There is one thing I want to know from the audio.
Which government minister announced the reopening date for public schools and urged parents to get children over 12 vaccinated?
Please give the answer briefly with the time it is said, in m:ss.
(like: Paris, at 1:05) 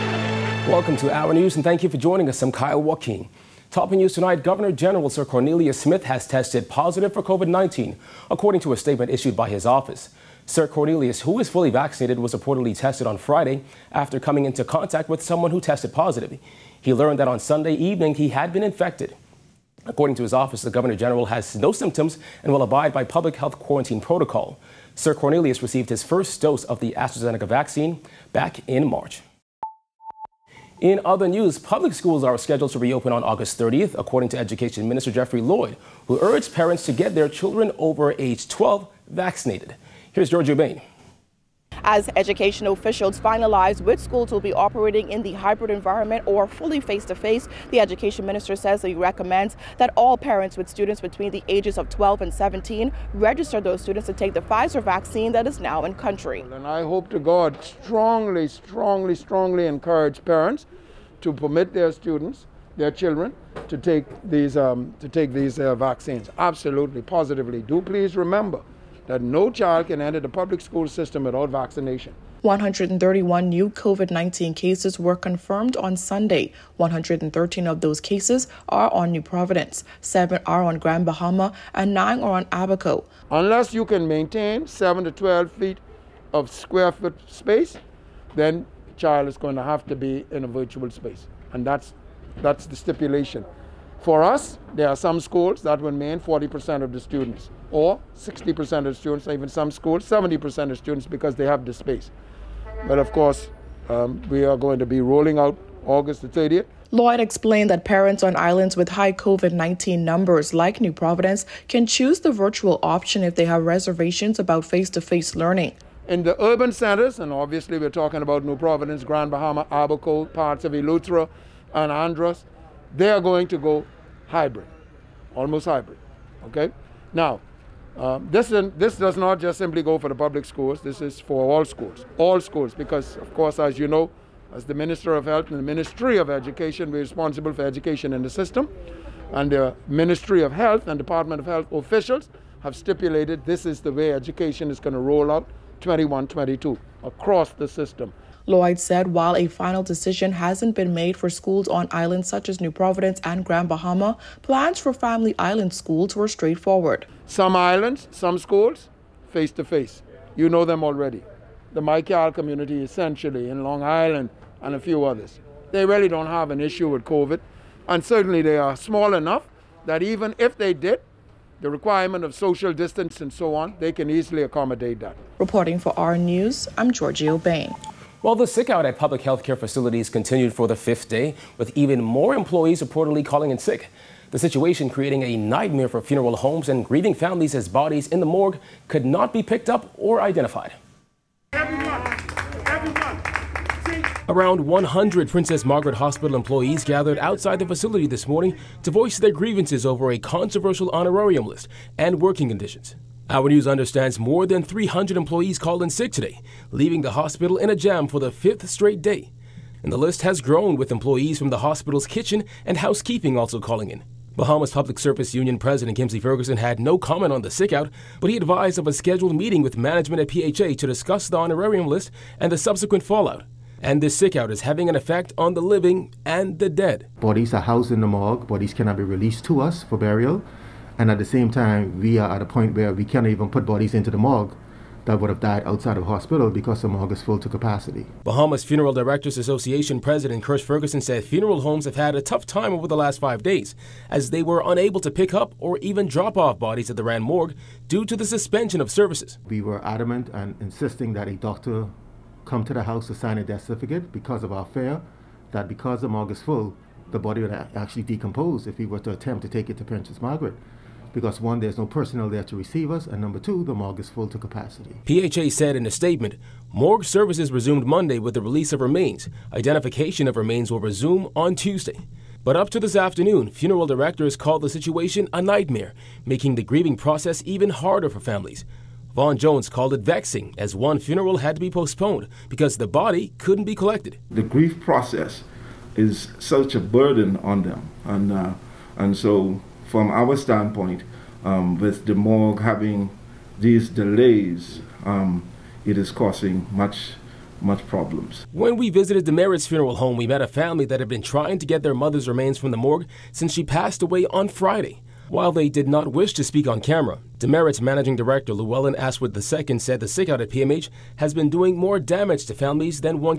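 Jeffrey Lloyd, at 0:35.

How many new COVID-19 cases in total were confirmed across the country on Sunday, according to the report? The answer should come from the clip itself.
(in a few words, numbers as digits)
131.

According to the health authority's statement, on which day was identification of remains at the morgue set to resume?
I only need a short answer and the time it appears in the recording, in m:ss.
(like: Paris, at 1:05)
Tuesday, at 4:31.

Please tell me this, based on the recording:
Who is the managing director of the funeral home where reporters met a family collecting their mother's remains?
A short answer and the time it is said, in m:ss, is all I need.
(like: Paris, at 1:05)
Llewellyn Ashwood II, at 5:08.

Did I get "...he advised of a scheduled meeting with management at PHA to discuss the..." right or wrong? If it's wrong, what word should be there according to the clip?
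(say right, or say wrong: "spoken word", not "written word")
right.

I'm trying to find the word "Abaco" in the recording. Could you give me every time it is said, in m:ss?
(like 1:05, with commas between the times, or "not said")
1:22, 1:59.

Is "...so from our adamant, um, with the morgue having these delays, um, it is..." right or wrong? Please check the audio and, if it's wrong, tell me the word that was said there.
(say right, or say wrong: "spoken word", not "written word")
wrong: "standpoint", not "adamant".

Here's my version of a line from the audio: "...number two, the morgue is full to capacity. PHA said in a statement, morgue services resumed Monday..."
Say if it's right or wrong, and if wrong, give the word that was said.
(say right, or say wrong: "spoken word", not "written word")
right.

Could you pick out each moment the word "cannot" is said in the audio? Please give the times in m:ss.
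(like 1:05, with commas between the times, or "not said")
3:48, 3:53.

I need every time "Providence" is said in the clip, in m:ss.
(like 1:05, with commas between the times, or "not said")
1:19, 1:50, 1:58, 2:32.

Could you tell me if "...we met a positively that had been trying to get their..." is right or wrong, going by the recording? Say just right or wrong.
wrong.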